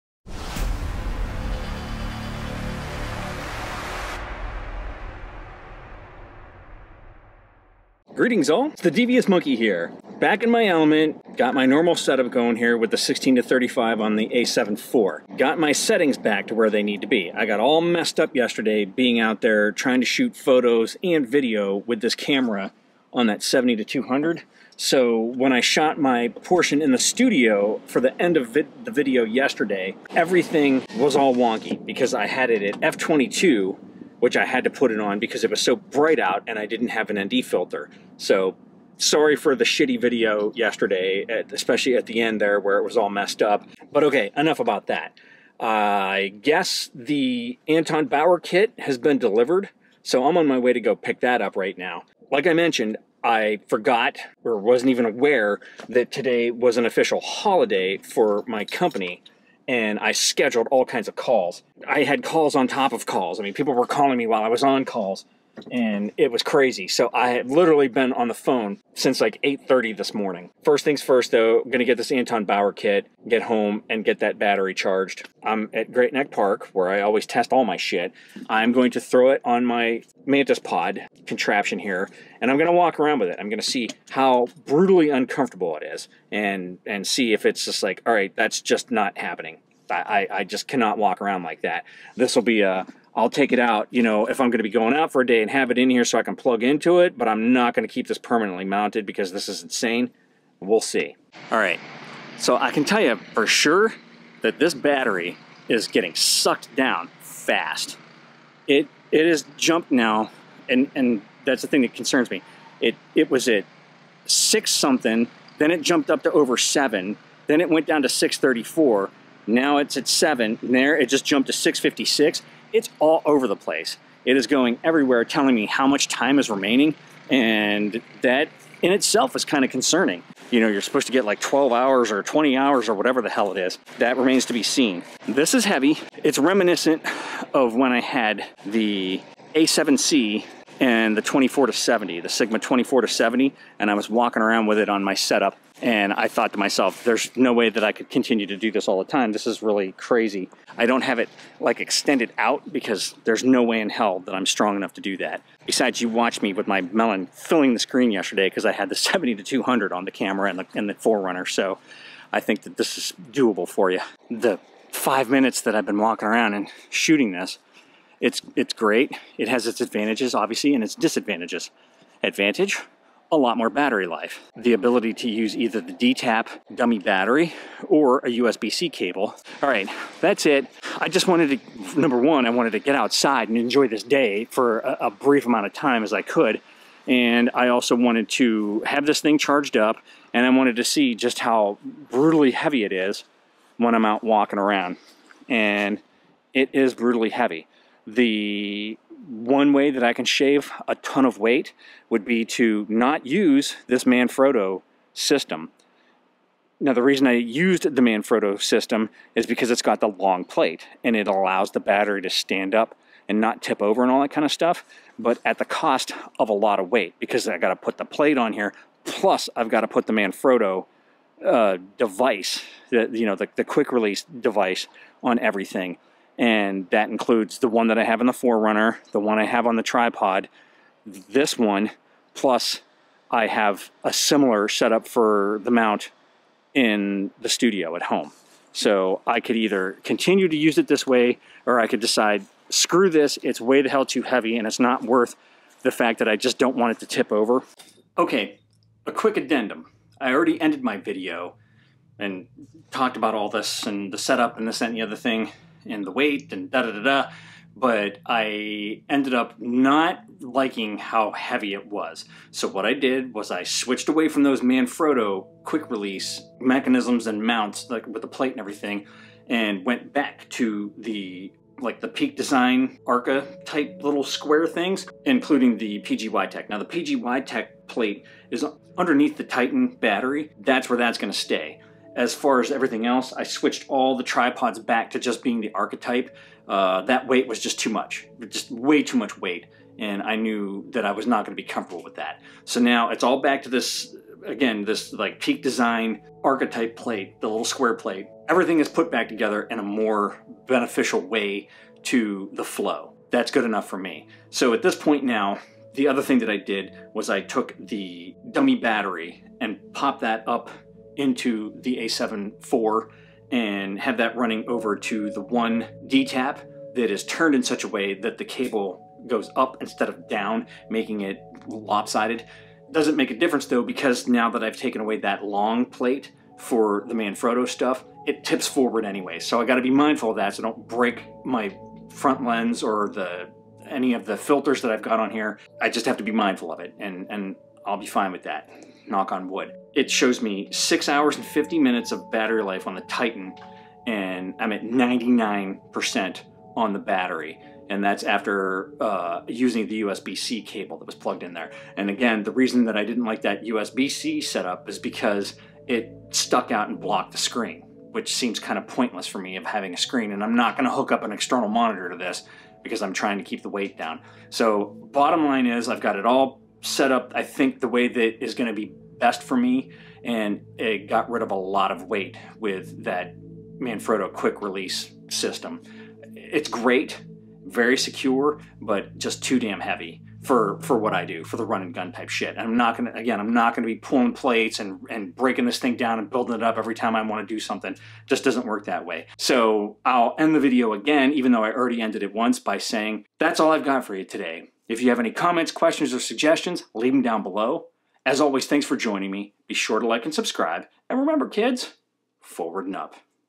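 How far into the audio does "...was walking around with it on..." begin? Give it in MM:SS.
02:23.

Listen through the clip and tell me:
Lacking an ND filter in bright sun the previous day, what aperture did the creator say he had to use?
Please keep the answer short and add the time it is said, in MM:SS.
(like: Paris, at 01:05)
f22, at 00:32.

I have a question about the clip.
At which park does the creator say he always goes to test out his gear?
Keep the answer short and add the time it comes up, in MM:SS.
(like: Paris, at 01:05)
Great Neck Park, at 01:15.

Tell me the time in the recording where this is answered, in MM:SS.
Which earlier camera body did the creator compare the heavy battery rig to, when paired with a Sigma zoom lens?
02:19.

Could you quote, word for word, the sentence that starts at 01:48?
It it is jumped now and and that's the thing that concerns me.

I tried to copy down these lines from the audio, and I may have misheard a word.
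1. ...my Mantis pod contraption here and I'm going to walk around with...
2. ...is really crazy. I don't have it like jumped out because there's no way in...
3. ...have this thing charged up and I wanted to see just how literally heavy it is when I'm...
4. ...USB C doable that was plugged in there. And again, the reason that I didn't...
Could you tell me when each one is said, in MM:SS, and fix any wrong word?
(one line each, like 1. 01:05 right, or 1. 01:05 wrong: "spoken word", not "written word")
1. 01:19 right
2. 02:29 wrong: "extended", not "jumped"
3. 03:08 wrong: "brutally", not "literally"
4. 05:50 wrong: "cable", not "doable".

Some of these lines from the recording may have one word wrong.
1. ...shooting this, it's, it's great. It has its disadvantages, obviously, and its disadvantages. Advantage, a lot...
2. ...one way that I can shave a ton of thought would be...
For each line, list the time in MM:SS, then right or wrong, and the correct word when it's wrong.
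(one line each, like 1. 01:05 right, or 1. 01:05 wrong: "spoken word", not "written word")
1. 02:46 wrong: "advantages", not "disadvantages"
2. 03:19 wrong: "weight", not "thought".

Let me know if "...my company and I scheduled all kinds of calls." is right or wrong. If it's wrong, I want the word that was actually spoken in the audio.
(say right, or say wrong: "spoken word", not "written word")
right.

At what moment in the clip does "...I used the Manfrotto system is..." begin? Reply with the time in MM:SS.
03:27.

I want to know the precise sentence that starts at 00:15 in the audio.
Got my settings back to where they need to be.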